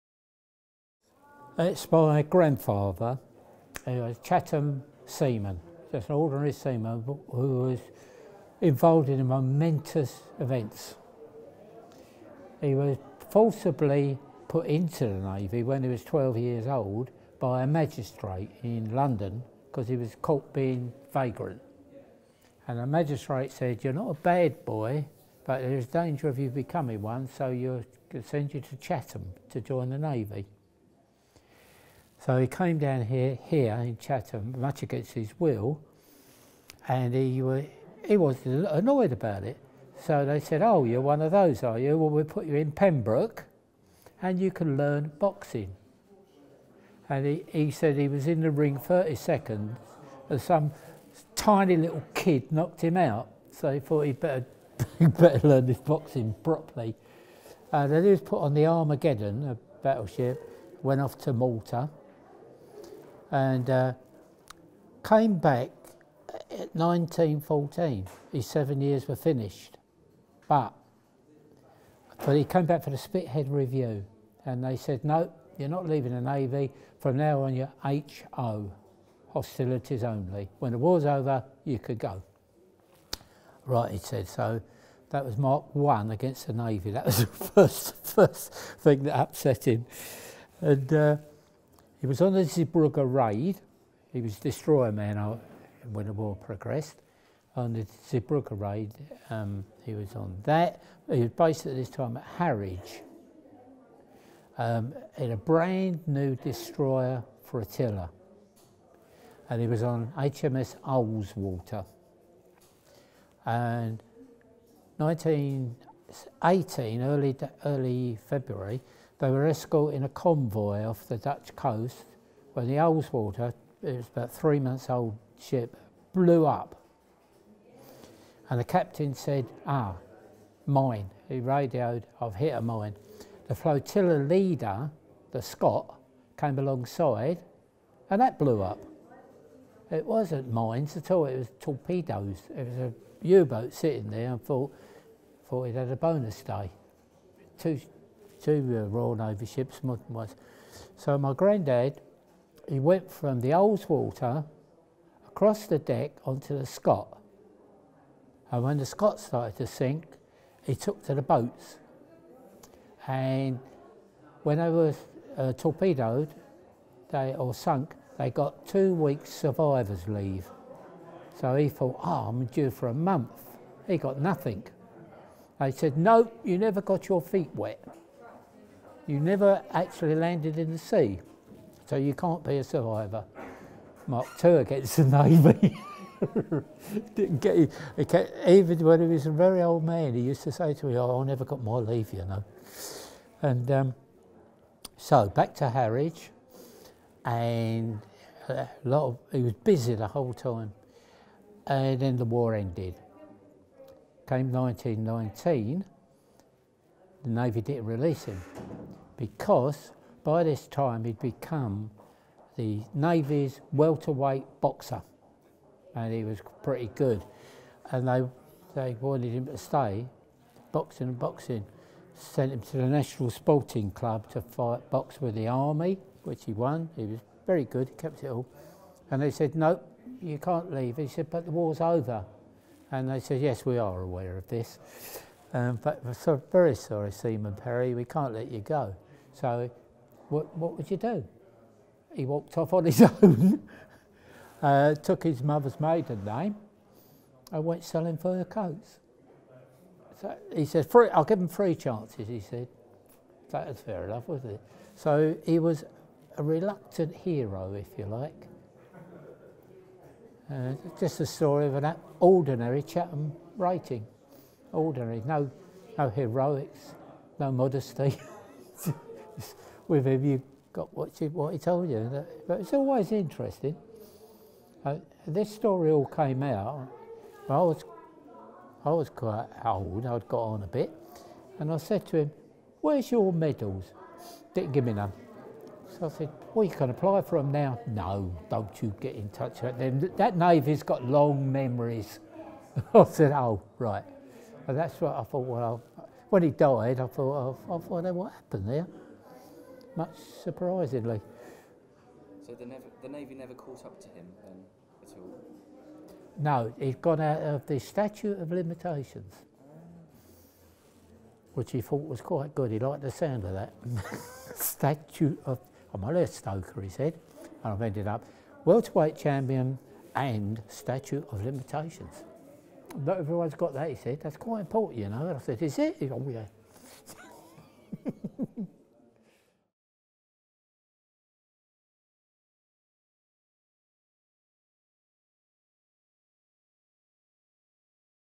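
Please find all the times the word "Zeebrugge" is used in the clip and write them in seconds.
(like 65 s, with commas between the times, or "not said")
92 s, 98 s.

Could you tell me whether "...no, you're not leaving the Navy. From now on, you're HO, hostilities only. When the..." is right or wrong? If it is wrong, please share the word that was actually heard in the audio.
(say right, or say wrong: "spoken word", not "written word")
right.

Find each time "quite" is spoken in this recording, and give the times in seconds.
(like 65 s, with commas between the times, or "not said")
279 s, 312 s, 324 s.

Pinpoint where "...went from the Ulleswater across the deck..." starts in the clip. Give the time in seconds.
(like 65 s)
152 s.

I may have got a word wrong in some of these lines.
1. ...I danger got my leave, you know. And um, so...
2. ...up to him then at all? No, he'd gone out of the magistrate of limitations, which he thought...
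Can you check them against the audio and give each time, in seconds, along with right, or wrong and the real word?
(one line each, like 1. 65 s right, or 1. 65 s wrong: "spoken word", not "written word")
1. 191 s wrong: "never", not "danger"
2. 303 s wrong: "statute", not "magistrate".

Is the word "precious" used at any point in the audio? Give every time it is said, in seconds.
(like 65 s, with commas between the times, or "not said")
not said.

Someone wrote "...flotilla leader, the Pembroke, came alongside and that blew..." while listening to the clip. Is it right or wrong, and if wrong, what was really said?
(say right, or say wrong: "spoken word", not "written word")
wrong: "Scott", not "Pembroke".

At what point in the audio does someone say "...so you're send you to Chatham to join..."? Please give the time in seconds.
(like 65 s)
27 s.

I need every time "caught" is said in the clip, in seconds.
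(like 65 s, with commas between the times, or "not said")
20 s, 303 s.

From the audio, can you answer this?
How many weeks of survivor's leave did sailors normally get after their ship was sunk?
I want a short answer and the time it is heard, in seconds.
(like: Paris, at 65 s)
2 weeks, at 168 s.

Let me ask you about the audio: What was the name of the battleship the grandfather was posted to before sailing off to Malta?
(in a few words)
Armageddon.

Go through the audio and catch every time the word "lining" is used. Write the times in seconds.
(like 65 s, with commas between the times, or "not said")
not said.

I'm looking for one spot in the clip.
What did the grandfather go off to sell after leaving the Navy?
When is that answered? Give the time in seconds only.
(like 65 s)
248 s.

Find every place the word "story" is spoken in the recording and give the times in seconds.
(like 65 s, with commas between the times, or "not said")
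261 s, 275 s.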